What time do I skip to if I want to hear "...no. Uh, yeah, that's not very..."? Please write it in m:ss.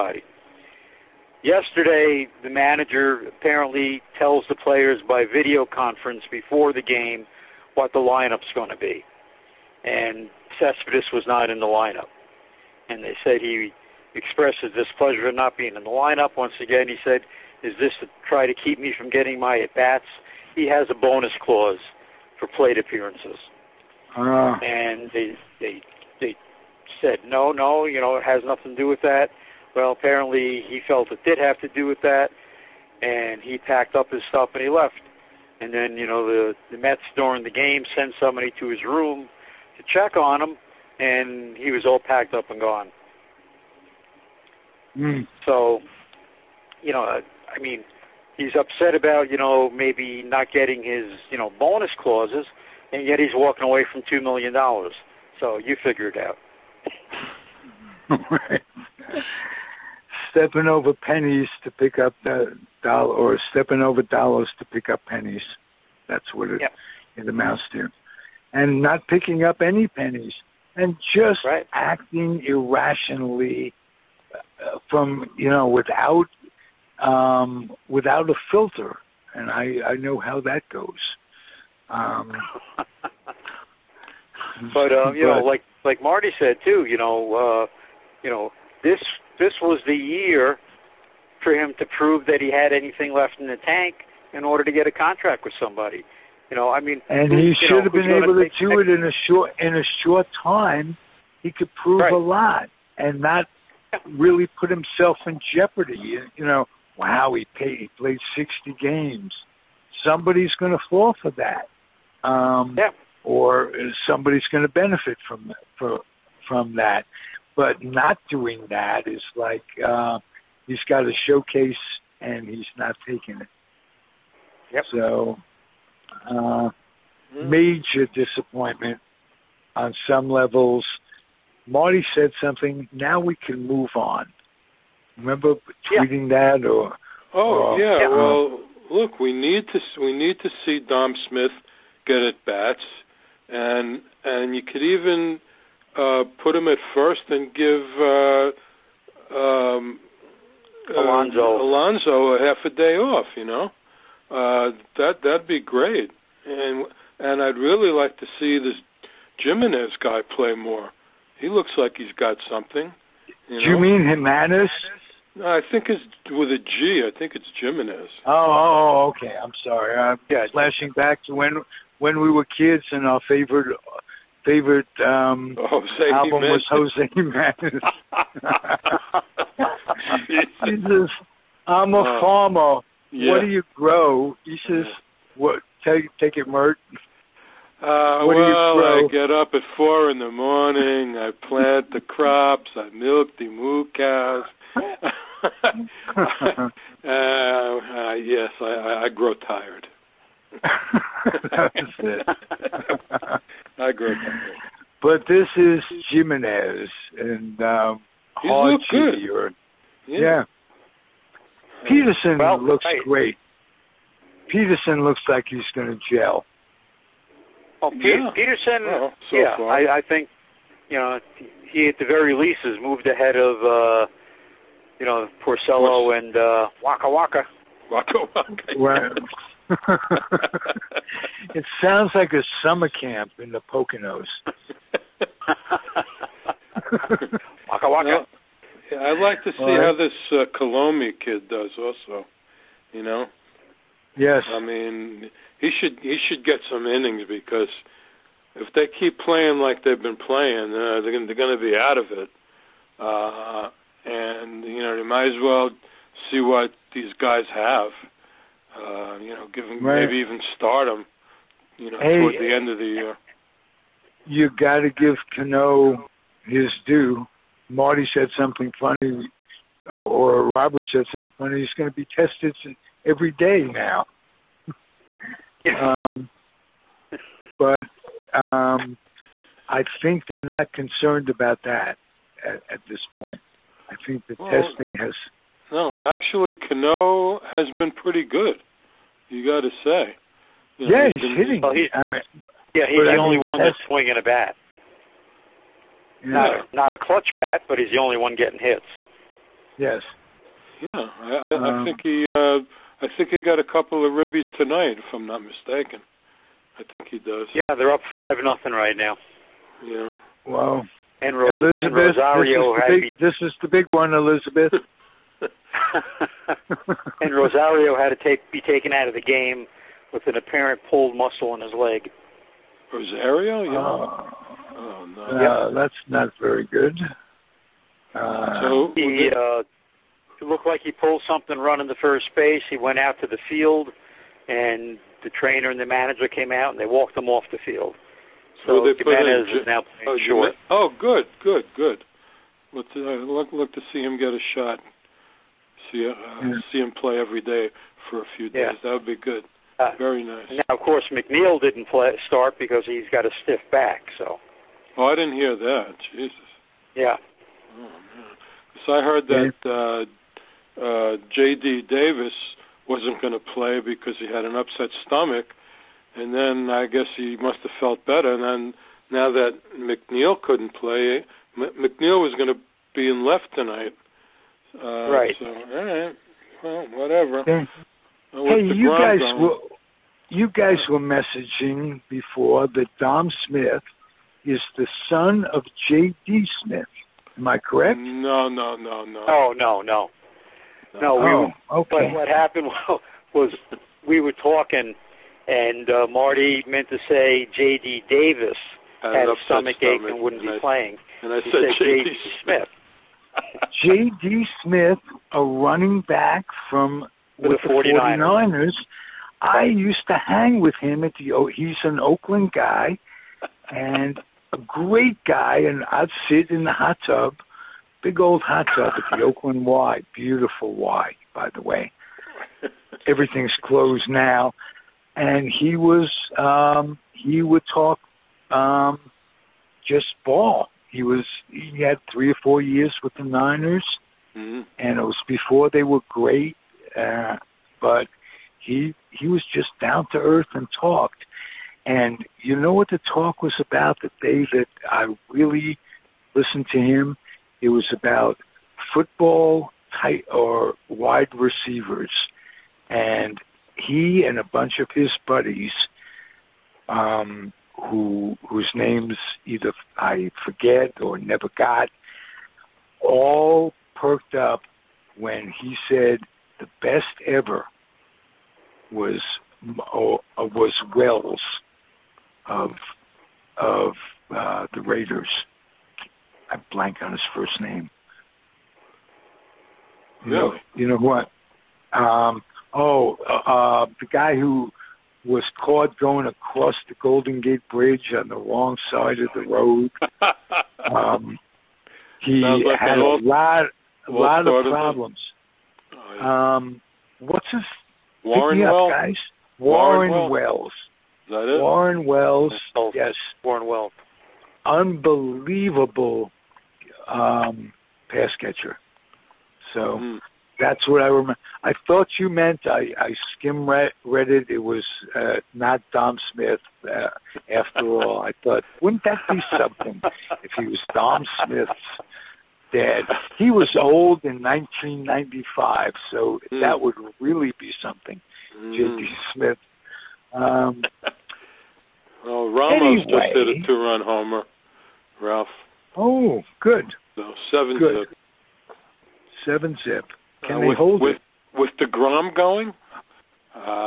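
5:25.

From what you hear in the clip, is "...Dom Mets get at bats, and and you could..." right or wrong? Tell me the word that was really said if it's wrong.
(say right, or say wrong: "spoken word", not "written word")
wrong: "Smith", not "Mets".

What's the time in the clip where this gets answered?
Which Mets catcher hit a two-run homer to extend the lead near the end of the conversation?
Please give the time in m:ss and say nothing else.
8:52.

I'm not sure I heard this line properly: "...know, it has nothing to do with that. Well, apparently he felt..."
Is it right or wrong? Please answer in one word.
right.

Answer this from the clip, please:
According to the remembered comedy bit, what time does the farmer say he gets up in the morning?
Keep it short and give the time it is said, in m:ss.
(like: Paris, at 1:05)
4 in the morning, at 3:09.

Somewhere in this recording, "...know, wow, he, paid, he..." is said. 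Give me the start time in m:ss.
1:46.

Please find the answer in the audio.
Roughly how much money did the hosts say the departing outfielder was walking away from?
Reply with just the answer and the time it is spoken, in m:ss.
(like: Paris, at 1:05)
2 million dollars, at 0:54.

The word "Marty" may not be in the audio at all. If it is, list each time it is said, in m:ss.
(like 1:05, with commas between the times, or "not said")
1:26, 2:11, 4:27, 6:36.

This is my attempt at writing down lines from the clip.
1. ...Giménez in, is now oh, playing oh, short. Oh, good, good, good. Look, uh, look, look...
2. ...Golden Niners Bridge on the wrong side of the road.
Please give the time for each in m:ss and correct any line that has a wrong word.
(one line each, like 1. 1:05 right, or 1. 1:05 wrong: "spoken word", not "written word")
1. 5:38 right
2. 8:07 wrong: "Gate", not "Niners".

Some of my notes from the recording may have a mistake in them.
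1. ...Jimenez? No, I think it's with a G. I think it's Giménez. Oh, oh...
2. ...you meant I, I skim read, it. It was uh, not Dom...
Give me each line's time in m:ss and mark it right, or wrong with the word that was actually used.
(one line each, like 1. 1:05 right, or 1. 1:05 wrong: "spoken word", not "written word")
1. 2:44 right
2. 8:32 right.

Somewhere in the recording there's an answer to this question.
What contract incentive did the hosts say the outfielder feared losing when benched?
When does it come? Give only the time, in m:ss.
0:22.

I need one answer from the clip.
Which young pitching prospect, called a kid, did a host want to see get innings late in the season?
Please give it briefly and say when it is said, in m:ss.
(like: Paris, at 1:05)
Kilome, at 4:00.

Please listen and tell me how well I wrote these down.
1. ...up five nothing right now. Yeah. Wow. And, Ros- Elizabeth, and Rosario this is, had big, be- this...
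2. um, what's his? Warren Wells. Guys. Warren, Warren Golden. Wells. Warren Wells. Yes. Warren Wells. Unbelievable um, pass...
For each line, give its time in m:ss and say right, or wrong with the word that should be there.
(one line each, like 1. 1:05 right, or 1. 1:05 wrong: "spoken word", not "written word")
1. 5:07 right
2. 8:16 wrong: "Wells", not "Golden".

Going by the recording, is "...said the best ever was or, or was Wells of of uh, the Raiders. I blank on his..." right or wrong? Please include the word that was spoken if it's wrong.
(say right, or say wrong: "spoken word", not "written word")
right.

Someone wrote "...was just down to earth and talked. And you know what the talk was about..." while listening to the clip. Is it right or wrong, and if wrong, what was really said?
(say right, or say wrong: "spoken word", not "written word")
right.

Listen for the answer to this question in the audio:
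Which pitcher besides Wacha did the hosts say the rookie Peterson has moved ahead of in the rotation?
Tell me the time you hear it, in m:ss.
3:45.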